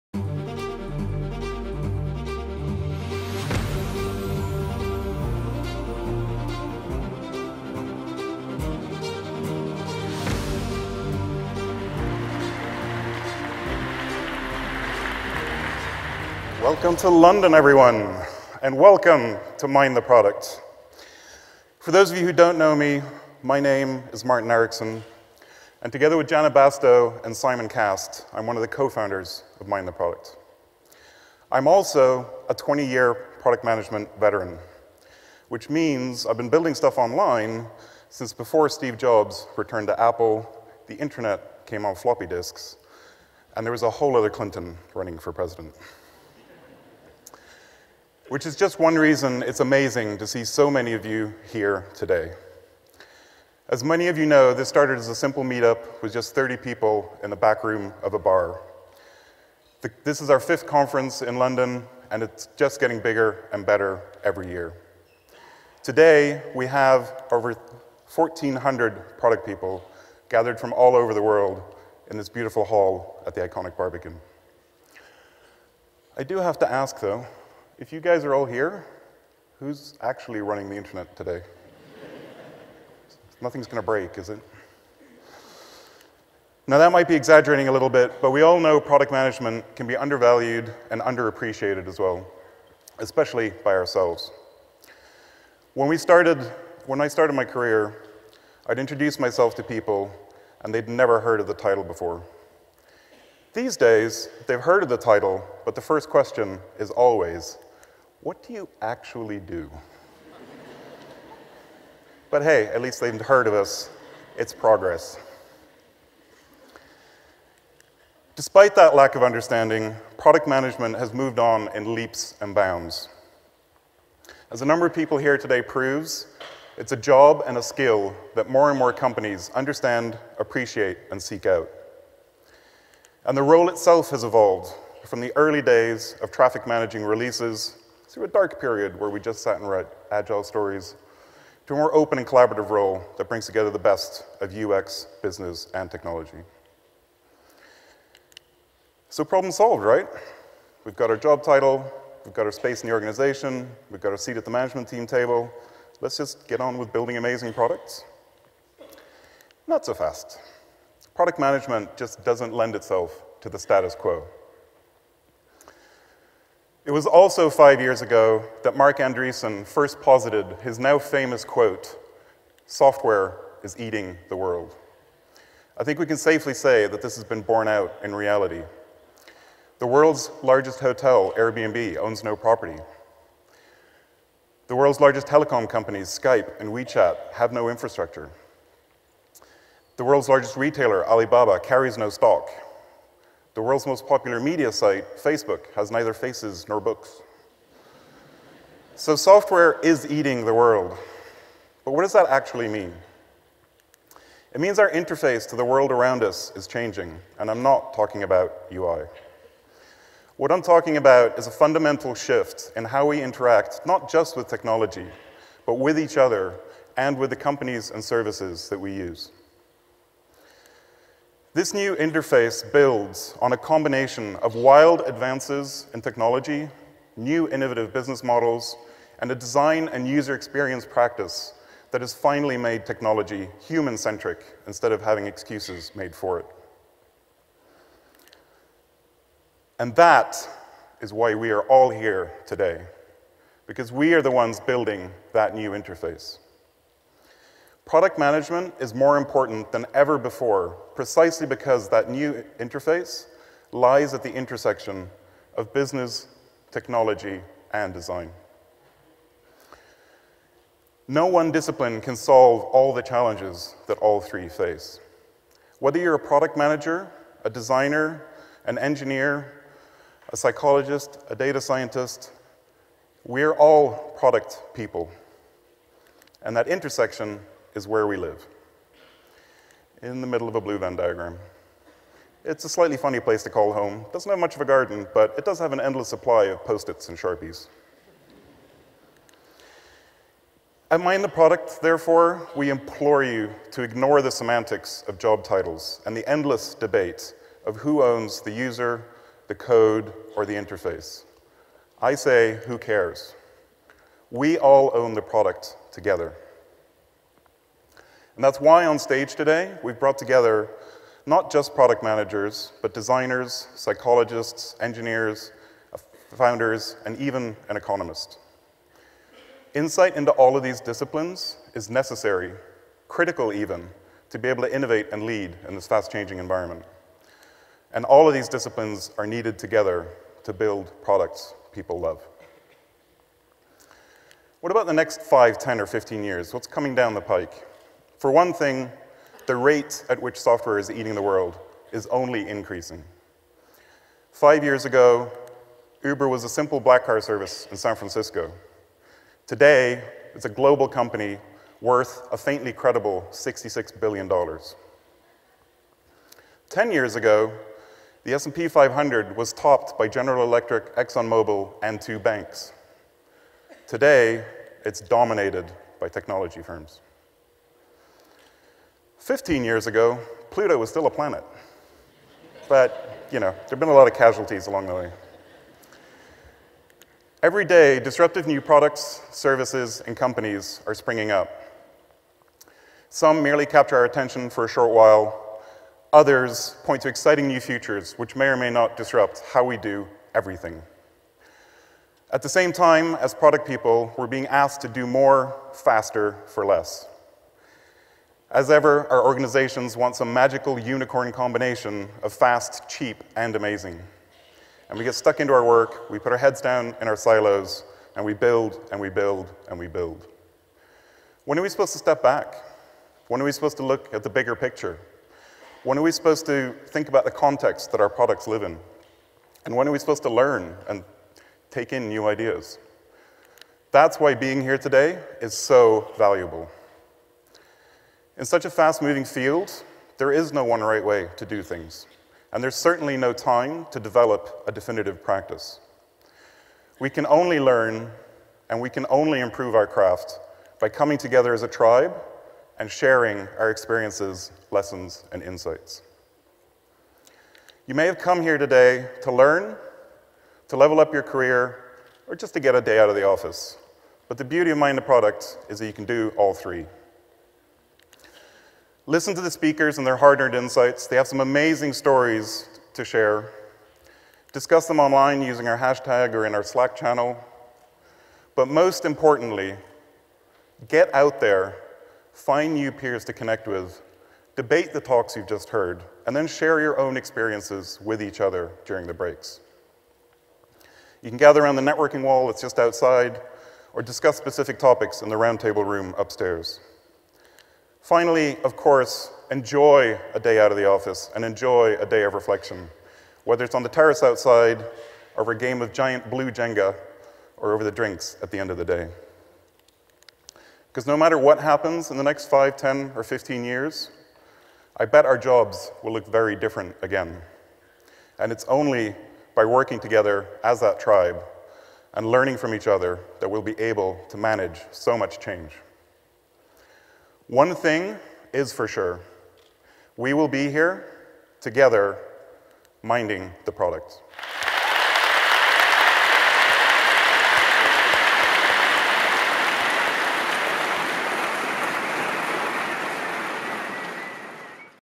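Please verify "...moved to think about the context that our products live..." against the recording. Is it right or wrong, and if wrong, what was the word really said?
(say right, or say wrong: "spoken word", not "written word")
wrong: "supposed", not "moved".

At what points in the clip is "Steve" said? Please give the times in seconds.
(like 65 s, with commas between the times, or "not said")
38 s.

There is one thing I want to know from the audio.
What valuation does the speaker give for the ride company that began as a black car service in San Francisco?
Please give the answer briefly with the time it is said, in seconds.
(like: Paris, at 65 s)
$66 billion, at 353 s.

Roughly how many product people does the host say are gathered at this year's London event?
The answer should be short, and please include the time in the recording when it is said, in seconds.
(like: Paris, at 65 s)
1,400, at 67 s.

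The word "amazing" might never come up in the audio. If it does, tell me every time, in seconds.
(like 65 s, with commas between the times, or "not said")
49 s, 157 s, 403 s, 461 s.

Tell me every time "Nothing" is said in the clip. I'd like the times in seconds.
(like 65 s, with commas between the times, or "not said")
83 s.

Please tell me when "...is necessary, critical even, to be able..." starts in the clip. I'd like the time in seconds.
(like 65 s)
321 s.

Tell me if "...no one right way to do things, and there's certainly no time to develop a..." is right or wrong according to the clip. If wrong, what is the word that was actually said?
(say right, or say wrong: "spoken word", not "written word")
right.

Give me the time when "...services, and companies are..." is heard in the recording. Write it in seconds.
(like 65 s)
379 s.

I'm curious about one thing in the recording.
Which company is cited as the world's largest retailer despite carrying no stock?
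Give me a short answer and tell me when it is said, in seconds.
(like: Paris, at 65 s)
Alibaba, at 191 s.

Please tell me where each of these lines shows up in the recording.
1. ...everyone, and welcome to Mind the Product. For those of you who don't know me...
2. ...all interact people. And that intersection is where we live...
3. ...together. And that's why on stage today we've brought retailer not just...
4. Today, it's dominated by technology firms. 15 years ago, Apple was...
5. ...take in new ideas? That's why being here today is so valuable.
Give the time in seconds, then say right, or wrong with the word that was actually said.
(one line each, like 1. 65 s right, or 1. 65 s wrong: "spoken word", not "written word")
1. 17 s right
2. 273 s wrong: "product", not "interact"
3. 305 s wrong: "together", not "retailer"
4. 363 s wrong: "Pluto", not "Apple"
5. 421 s right.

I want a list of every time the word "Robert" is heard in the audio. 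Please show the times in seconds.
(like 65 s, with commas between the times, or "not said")
not said.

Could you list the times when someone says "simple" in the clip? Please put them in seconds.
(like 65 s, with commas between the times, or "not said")
55 s, 346 s.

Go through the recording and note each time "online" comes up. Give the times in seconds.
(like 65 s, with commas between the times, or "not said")
36 s, 464 s.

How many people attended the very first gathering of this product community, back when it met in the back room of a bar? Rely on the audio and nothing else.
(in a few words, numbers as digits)
30.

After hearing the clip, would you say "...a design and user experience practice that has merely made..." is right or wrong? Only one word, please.
wrong.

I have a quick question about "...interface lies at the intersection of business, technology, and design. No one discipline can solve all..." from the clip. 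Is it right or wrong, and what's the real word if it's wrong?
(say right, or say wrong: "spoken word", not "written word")
right.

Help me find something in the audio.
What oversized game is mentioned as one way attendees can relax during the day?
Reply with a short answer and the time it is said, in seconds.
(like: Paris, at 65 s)
giant blue Jenga, at 495 s.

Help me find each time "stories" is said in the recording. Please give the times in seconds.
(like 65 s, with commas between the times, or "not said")
140 s, 461 s.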